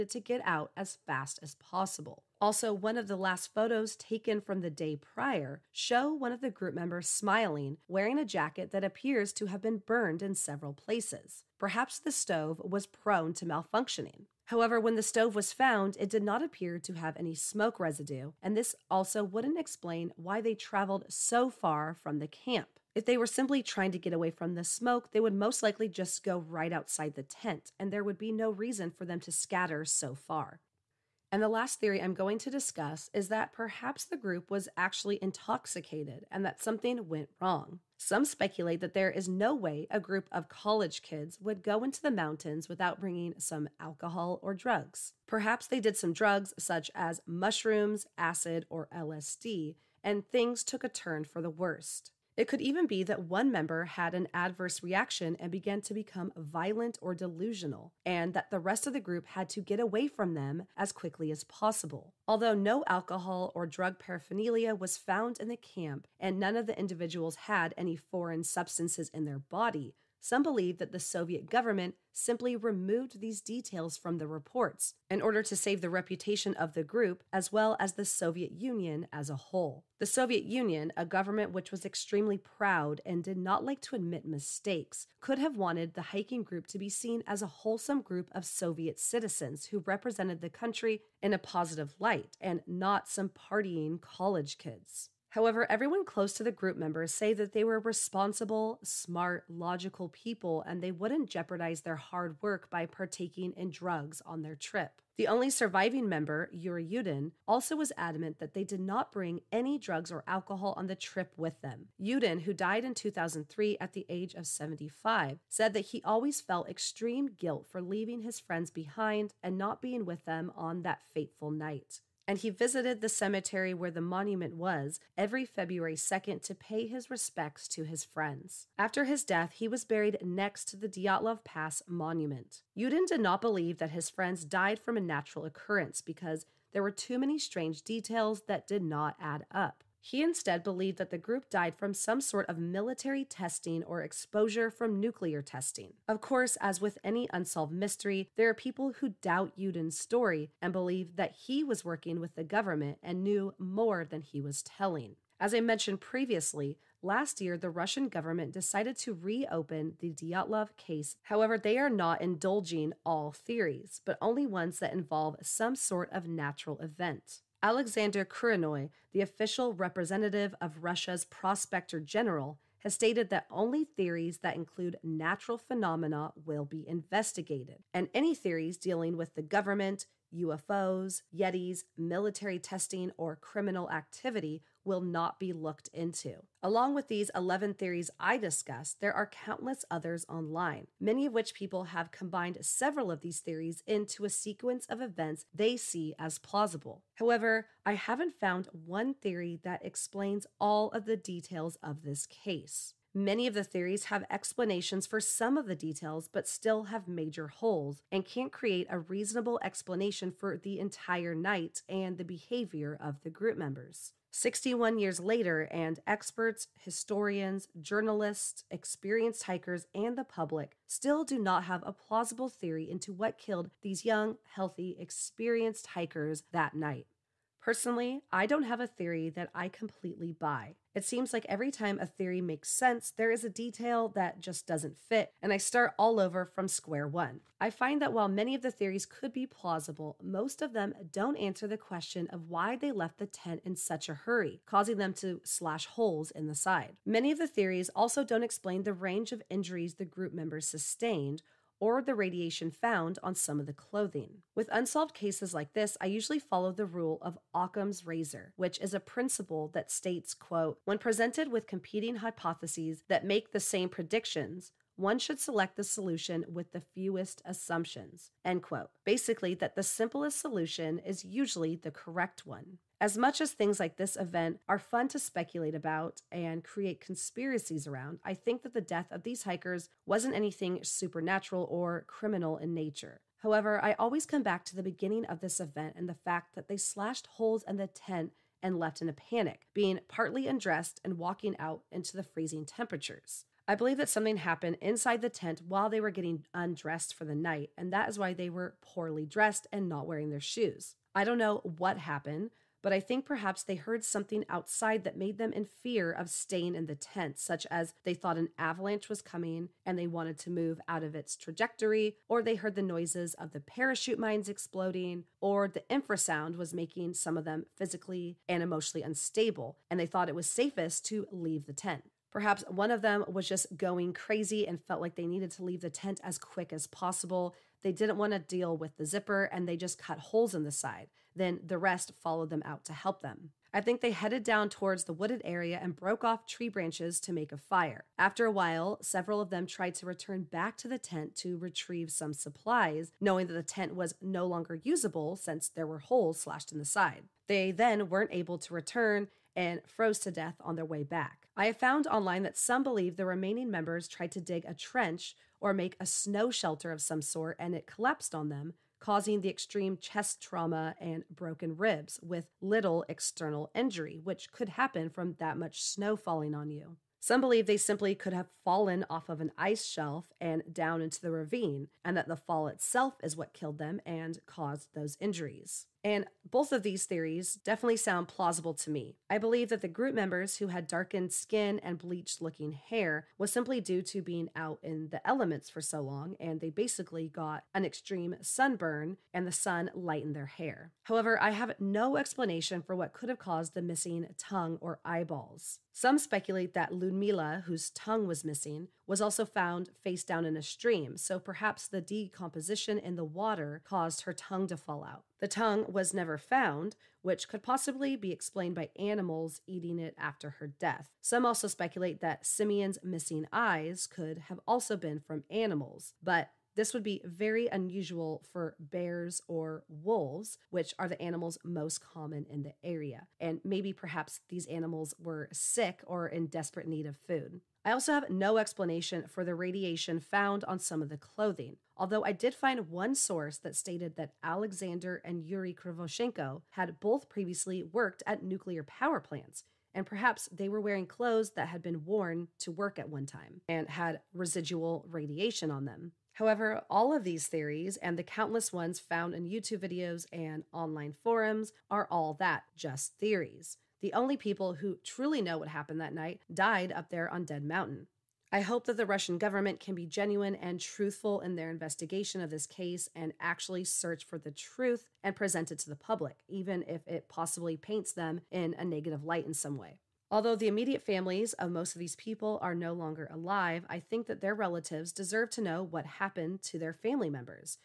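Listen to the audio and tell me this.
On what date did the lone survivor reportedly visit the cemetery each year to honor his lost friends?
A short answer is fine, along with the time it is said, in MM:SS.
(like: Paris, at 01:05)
February 2, at 02:05.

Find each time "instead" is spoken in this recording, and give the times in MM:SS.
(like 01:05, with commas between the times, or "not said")
02:20.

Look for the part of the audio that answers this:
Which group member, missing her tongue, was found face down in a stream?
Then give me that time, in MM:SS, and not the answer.
06:36.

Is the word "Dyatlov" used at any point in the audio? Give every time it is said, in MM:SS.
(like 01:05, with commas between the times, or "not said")
02:10, 02:40.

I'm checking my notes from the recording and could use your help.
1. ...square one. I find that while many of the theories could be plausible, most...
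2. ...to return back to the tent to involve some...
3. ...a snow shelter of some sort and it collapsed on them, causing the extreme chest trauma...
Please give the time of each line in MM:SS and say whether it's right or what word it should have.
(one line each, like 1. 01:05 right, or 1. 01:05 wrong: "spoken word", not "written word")
1. 03:56 right
2. 05:39 wrong: "retrieve", not "involve"
3. 05:55 right.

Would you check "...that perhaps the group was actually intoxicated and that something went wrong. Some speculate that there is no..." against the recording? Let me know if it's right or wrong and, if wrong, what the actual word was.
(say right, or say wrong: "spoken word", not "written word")
right.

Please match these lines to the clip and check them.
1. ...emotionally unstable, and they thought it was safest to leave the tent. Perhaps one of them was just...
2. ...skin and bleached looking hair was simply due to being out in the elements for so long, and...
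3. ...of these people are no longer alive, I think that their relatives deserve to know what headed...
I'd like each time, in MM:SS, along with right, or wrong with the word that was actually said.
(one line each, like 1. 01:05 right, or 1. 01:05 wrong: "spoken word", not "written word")
1. 05:18 right
2. 06:21 right
3. 07:51 wrong: "happened", not "headed".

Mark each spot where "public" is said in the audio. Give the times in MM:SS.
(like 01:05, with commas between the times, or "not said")
03:40, 07:45.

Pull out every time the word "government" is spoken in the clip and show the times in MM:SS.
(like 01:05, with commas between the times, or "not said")
01:11, 01:21, 02:32, 02:38, 02:59, 07:39.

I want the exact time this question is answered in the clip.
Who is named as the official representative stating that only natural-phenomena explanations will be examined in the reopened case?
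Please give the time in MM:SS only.
02:47.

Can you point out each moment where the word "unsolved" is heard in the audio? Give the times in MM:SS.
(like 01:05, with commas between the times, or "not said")
02:27, 04:14.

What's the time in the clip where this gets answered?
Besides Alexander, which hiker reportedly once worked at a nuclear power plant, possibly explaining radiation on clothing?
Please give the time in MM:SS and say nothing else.
07:15.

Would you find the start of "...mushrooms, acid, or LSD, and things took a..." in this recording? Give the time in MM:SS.
00:47.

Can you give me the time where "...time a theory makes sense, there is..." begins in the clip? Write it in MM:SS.
03:51.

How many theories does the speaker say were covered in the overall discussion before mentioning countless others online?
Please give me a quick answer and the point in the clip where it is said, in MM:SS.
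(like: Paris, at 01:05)
11, at 03:07.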